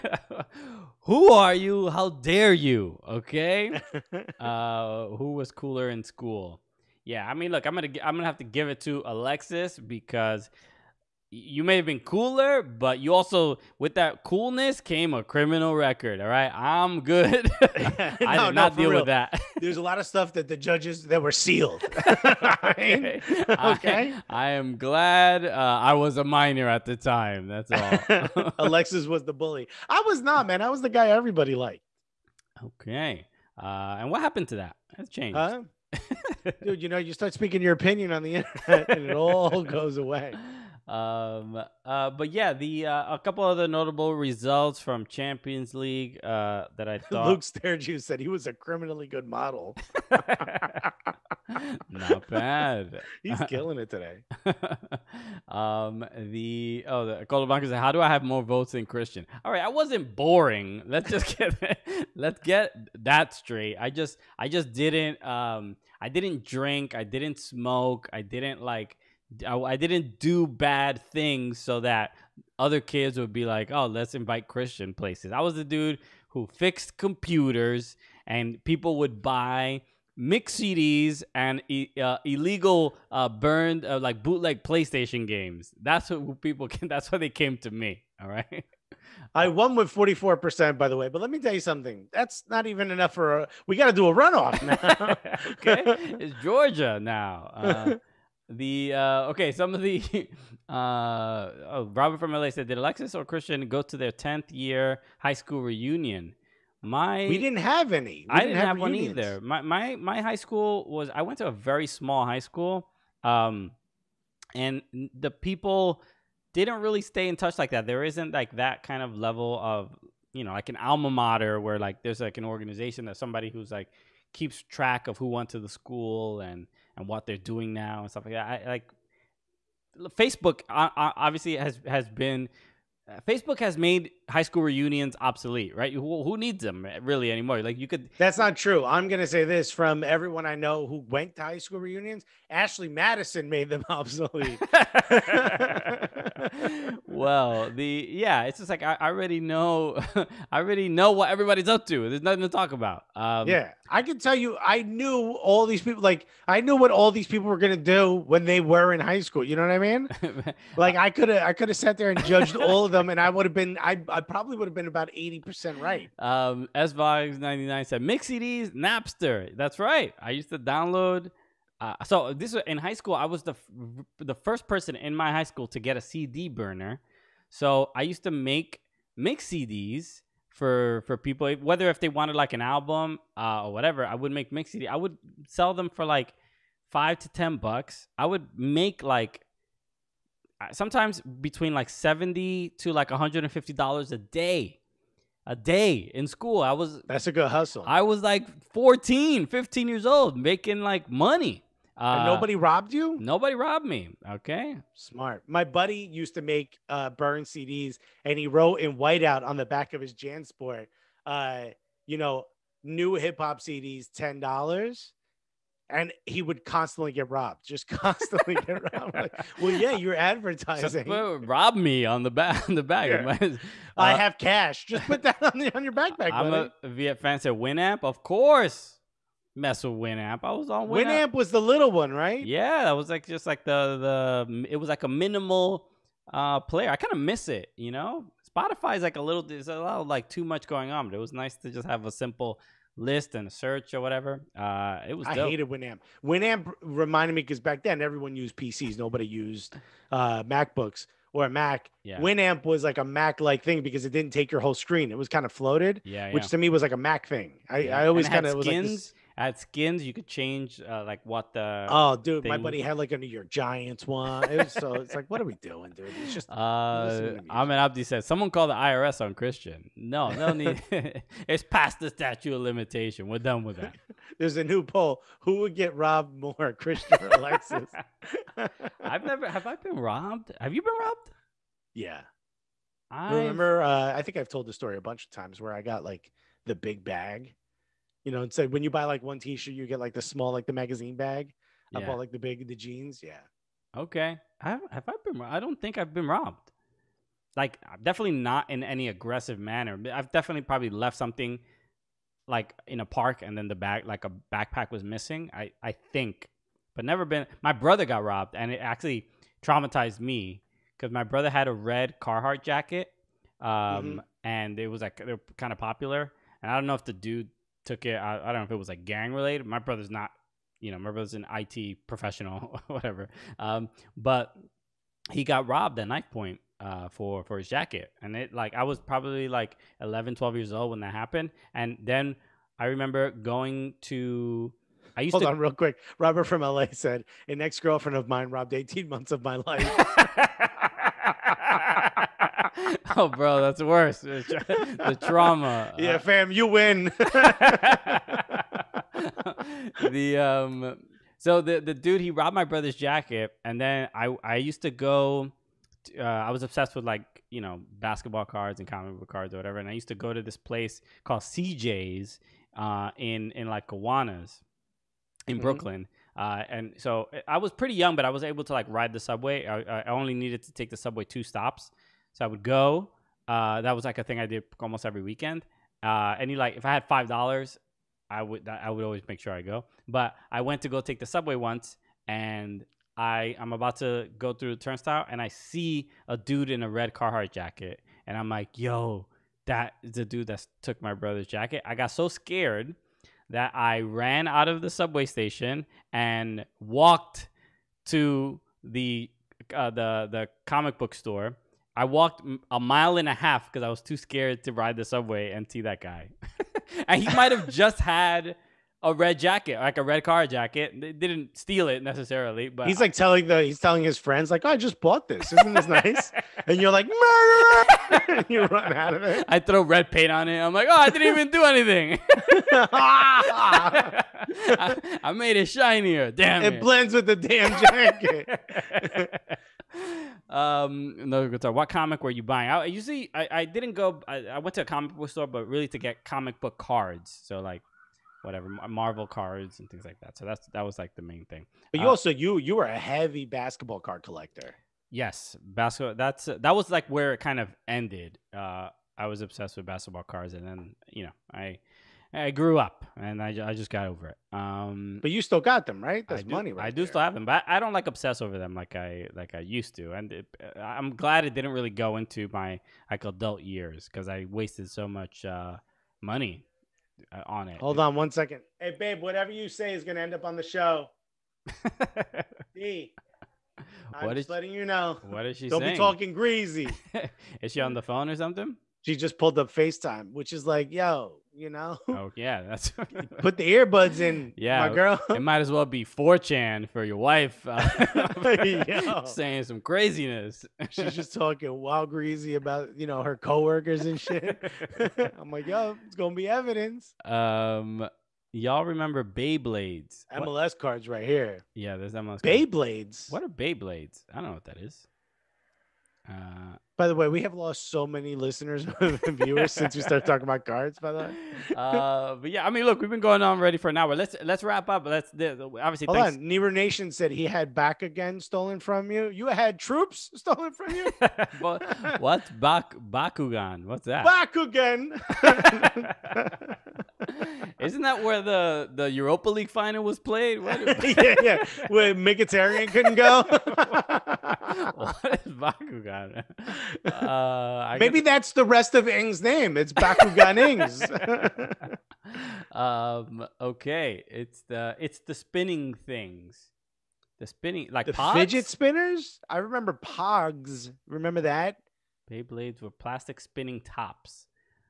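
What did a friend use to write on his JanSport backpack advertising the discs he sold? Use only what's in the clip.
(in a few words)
Whiteout.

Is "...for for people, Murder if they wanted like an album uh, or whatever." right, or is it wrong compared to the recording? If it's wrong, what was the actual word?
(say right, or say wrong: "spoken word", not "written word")
wrong: "whether", not "Murder".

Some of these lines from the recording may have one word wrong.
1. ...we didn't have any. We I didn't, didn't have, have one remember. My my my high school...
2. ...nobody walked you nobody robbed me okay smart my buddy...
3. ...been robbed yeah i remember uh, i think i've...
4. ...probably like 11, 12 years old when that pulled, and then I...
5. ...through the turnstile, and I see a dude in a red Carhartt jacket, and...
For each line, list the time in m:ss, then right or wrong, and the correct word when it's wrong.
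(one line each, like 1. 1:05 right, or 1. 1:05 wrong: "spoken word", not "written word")
1. 1:47 wrong: "either", not "remember"
2. 3:22 wrong: "robbed", not "walked"
3. 4:40 right
4. 5:28 wrong: "happened", not "pulled"
5. 6:24 right.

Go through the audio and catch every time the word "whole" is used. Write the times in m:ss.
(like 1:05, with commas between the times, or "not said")
4:14.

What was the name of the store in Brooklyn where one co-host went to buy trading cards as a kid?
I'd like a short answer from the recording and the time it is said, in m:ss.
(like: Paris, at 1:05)
CJ's, at 6:01.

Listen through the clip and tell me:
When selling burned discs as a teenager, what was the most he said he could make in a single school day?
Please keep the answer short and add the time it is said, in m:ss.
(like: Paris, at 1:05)
$150, at 3:13.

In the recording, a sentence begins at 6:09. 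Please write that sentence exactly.
I, I only needed to take the subway two stops so I would go.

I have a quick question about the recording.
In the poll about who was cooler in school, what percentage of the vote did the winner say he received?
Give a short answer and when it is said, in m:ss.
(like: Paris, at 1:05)
44%, at 1:29.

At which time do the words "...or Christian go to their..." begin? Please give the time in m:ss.
1:43.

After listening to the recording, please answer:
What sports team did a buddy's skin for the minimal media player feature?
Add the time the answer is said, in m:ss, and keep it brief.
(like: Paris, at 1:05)
New York Giants, at 4:23.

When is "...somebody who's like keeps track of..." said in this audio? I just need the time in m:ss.
2:03.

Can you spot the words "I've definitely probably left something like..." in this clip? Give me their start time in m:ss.
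5:00.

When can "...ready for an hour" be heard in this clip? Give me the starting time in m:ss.
8:33.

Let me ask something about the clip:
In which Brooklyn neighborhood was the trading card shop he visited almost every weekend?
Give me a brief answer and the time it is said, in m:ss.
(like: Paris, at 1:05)
Gowanus, at 6:03.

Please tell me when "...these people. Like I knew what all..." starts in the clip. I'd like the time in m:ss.
2:35.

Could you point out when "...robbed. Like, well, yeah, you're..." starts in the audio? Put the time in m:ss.
3:38.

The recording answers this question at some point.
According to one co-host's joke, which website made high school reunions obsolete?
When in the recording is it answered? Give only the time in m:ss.
2:22.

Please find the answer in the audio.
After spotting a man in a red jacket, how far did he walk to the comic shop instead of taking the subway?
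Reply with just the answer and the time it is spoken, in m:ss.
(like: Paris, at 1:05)
A mile and a half, at 6:42.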